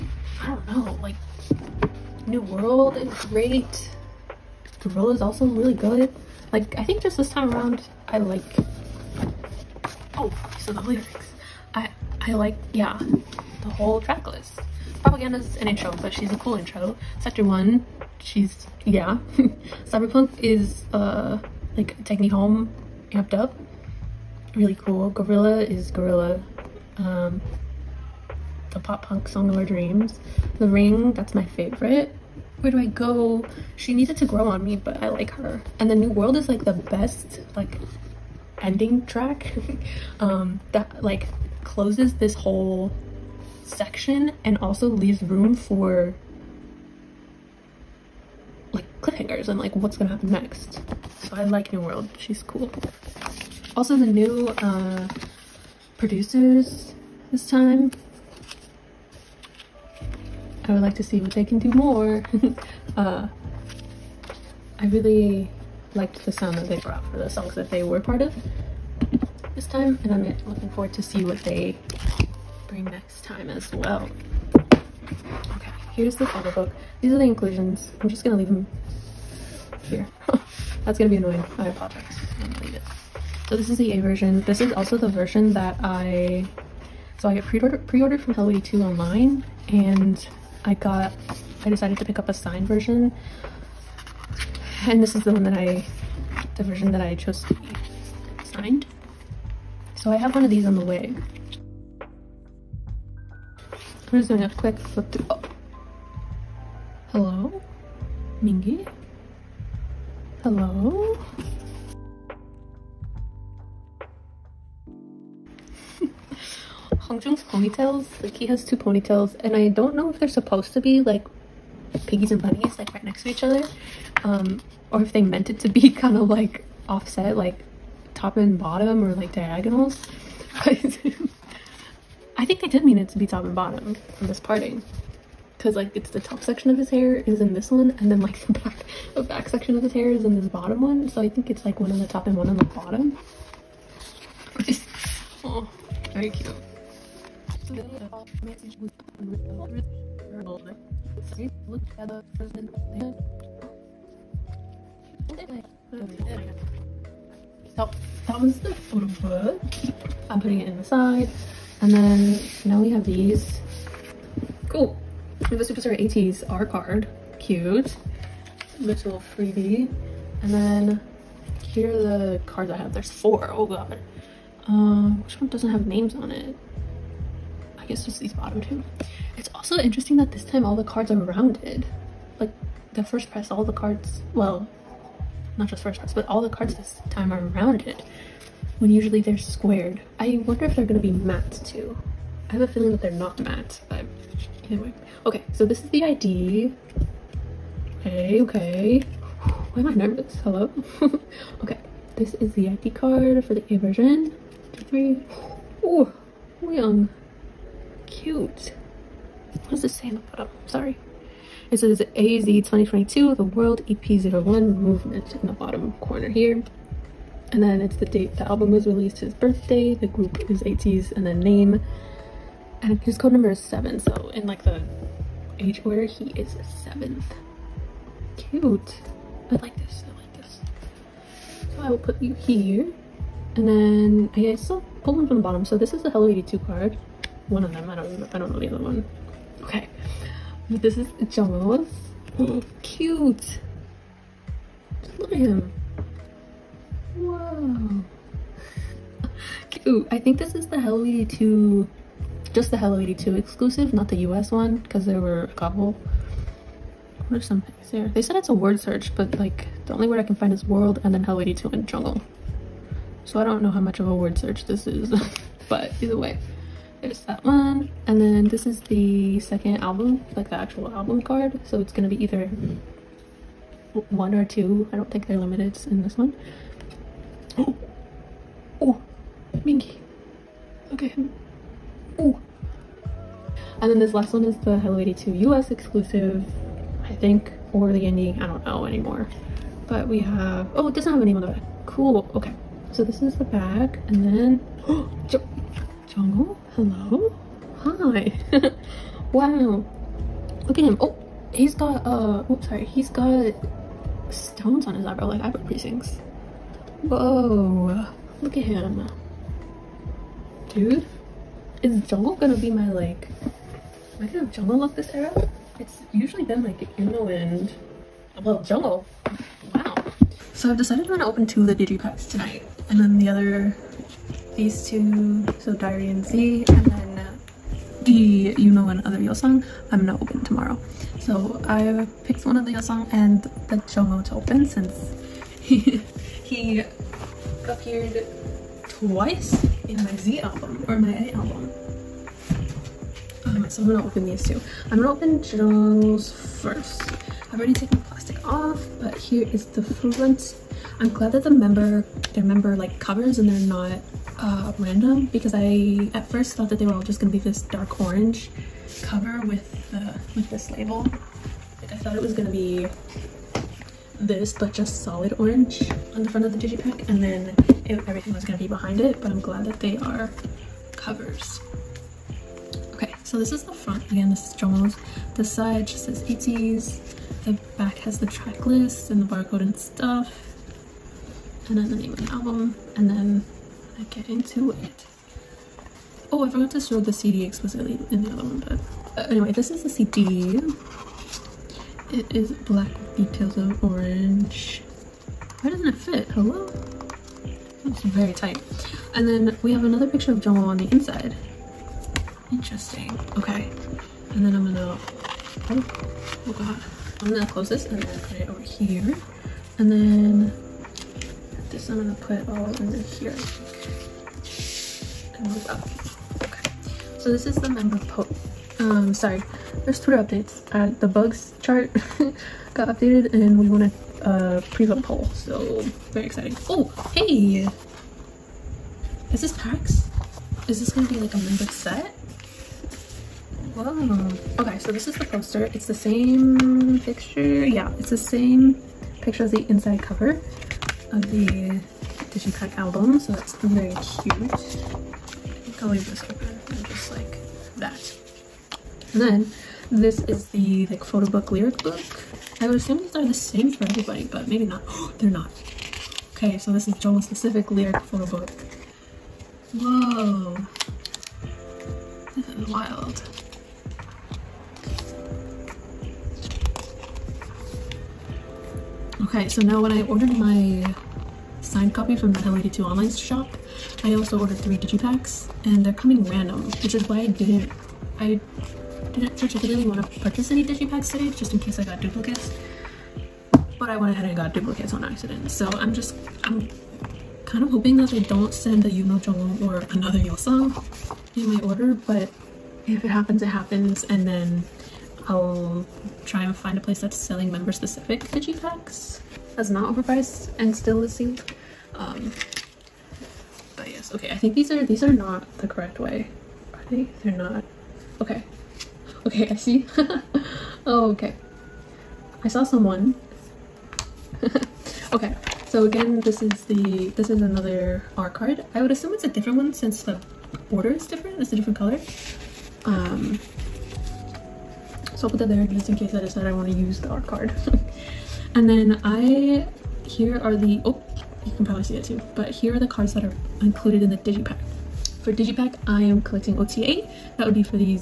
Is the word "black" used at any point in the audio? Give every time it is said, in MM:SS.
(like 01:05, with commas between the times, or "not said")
06:32.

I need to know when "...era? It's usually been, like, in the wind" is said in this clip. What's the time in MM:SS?
05:15.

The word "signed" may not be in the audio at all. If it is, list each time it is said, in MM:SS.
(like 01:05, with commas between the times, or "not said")
01:32, 01:38, 07:51.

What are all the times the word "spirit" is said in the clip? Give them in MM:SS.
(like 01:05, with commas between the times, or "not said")
not said.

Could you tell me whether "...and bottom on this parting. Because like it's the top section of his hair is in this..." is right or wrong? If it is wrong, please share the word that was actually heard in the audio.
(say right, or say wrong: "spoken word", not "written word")
right.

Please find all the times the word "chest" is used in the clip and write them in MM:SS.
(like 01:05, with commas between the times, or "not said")
not said.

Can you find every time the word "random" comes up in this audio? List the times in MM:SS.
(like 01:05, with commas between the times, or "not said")
05:54, 07:56.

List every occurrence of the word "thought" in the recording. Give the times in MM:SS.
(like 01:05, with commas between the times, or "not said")
05:56, 06:01.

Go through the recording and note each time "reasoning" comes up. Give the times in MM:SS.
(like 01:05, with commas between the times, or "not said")
not said.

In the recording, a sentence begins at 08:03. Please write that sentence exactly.
But I went ahead and got duplicates on accident.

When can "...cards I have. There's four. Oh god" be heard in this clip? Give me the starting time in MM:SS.
02:52.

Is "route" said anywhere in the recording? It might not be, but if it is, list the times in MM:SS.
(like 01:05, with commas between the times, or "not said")
not said.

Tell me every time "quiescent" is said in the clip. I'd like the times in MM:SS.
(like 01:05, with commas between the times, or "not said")
not said.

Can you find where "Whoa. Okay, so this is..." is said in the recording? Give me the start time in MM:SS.
07:13.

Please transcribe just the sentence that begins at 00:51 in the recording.
So I like New World, she's cool.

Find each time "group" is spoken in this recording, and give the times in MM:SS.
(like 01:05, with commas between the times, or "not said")
03:40.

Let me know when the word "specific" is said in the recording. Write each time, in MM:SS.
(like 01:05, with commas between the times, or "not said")
07:37, 08:17.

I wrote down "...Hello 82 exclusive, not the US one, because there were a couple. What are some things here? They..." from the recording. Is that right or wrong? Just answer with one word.
right.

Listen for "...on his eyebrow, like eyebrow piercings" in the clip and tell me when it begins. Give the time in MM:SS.
05:04.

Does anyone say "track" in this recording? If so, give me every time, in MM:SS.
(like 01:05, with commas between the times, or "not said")
00:14, 00:39, 06:18.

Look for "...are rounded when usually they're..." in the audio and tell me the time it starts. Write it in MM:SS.
03:07.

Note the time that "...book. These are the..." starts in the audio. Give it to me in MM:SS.
01:16.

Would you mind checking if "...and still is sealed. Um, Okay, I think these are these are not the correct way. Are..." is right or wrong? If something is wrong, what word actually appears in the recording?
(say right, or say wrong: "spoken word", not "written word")
right.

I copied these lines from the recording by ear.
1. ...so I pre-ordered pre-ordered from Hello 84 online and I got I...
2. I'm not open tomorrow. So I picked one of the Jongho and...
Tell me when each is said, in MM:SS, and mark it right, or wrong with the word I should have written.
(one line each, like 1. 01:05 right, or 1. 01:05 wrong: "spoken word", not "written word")
1. 01:27 wrong: "82", not "84"
2. 05:29 wrong: "Song", not "Jongho".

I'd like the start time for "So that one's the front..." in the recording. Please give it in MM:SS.
02:37.